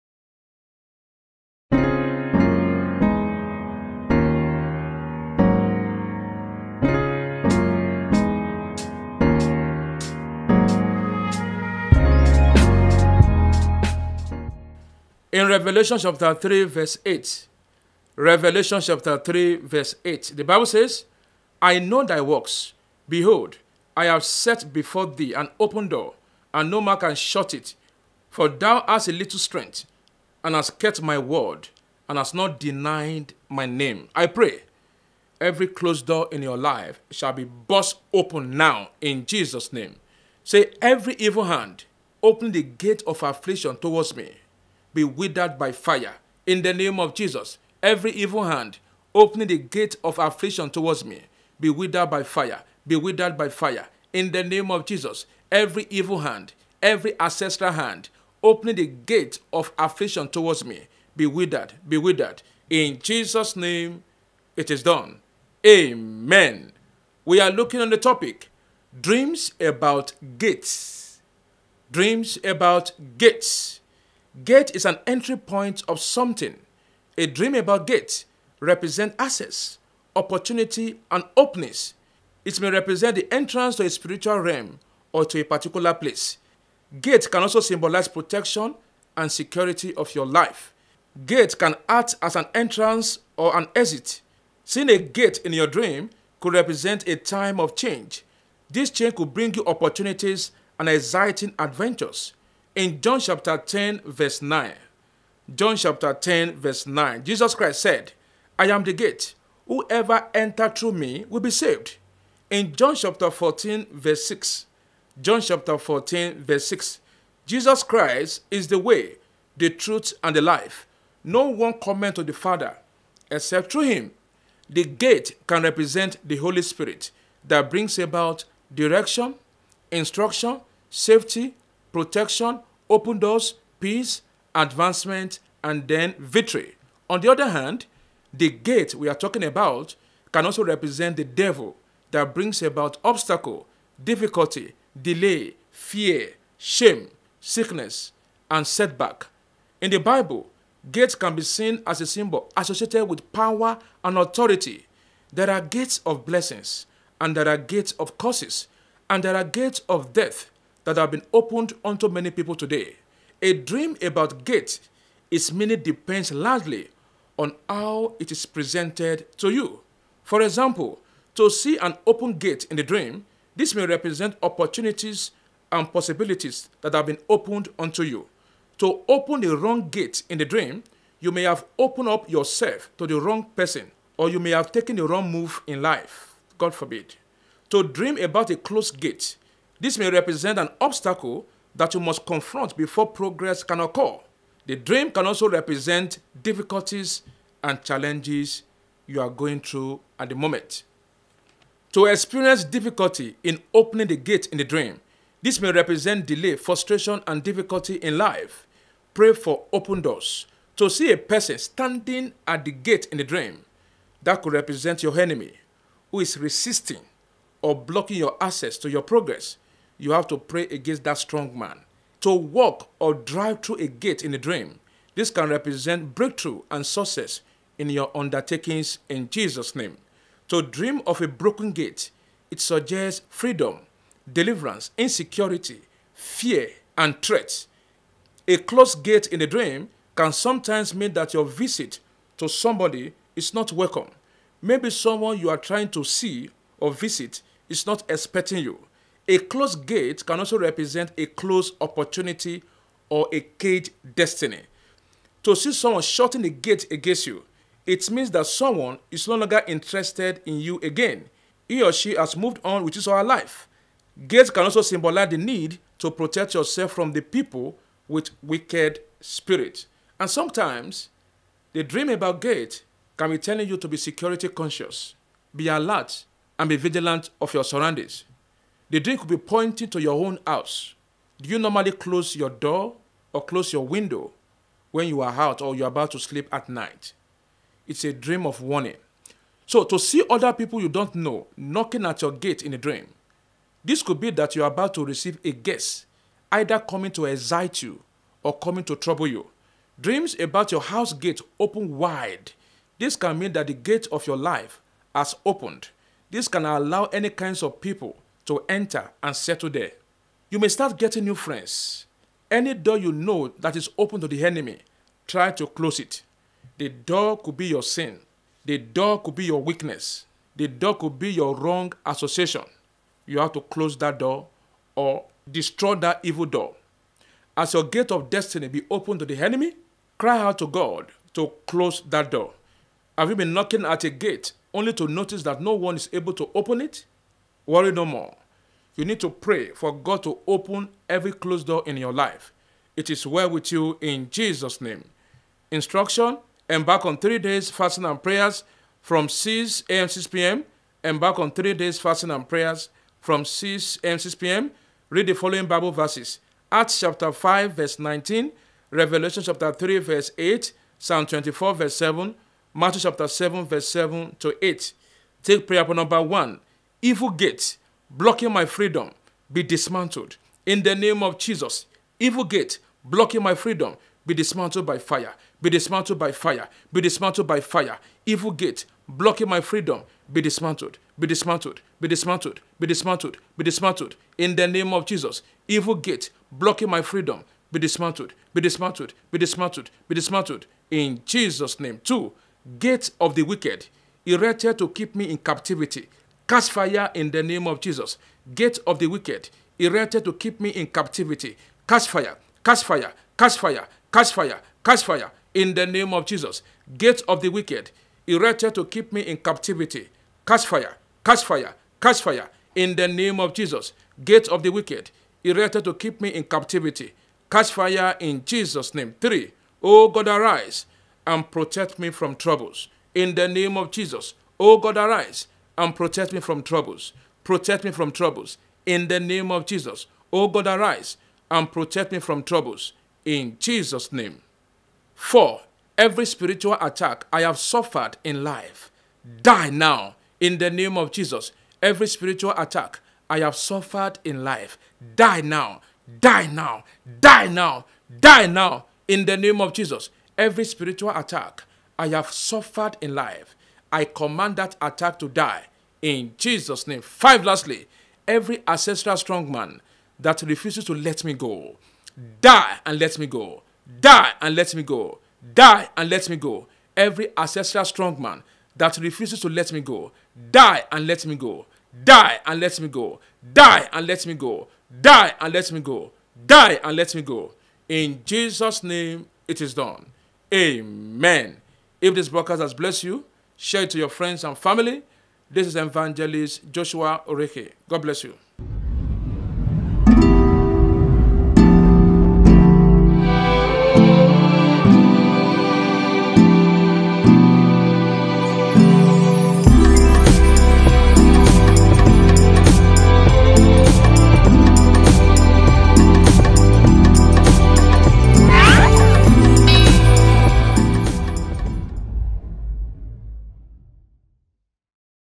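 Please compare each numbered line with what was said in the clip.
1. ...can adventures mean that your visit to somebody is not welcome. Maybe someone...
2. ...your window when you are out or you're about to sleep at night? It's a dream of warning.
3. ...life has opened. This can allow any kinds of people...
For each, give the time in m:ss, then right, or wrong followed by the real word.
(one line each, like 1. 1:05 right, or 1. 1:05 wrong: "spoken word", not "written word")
1. 4:00 wrong: "sometimes", not "adventures"
2. 4:43 right
3. 5:04 right.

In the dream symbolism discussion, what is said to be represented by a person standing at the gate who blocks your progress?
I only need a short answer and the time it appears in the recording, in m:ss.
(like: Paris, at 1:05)
Your enemy, at 3:35.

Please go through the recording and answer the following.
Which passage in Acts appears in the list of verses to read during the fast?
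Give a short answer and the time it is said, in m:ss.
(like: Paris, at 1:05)
Acts 5:19, at 5:56.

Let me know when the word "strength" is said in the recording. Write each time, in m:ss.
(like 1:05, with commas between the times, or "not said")
0:29.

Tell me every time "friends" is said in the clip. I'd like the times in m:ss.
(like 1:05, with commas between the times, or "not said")
5:11, 8:04.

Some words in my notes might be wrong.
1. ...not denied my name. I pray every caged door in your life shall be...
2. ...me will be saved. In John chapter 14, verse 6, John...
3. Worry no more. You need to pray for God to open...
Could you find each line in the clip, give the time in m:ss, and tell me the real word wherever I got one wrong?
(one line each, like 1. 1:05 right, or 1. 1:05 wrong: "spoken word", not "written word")
1. 0:32 wrong: "closed", not "caged"
2. 1:50 right
3. 5:37 right.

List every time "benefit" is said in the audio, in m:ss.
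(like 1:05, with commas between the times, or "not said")
not said.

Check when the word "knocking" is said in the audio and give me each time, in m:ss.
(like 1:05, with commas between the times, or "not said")
4:51, 5:33.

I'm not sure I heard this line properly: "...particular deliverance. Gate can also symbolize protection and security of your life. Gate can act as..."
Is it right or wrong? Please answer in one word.
wrong.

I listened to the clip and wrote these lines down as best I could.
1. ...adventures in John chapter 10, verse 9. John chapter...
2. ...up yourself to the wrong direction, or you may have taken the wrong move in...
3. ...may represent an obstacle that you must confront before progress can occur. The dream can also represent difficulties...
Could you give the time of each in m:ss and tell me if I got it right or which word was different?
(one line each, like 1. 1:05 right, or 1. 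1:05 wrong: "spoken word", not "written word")
1. 1:41 right
2. 3:02 wrong: "person", not "direction"
3. 3:09 right.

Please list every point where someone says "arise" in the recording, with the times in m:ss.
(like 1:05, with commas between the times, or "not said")
7:00, 7:04, 7:10.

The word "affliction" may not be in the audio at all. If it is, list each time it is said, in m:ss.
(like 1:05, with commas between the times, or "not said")
0:43, 0:50, 0:59.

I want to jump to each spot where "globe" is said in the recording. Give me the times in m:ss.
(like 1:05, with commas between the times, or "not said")
not said.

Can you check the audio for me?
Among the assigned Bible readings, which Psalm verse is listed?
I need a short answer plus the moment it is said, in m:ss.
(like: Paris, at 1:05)
Psalm 24:7, at 6:00.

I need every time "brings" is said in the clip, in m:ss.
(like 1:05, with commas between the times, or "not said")
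1:39, 2:07, 2:22.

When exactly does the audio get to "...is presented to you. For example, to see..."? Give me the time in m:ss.
2:48.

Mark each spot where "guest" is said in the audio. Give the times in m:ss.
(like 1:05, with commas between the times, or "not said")
4:55.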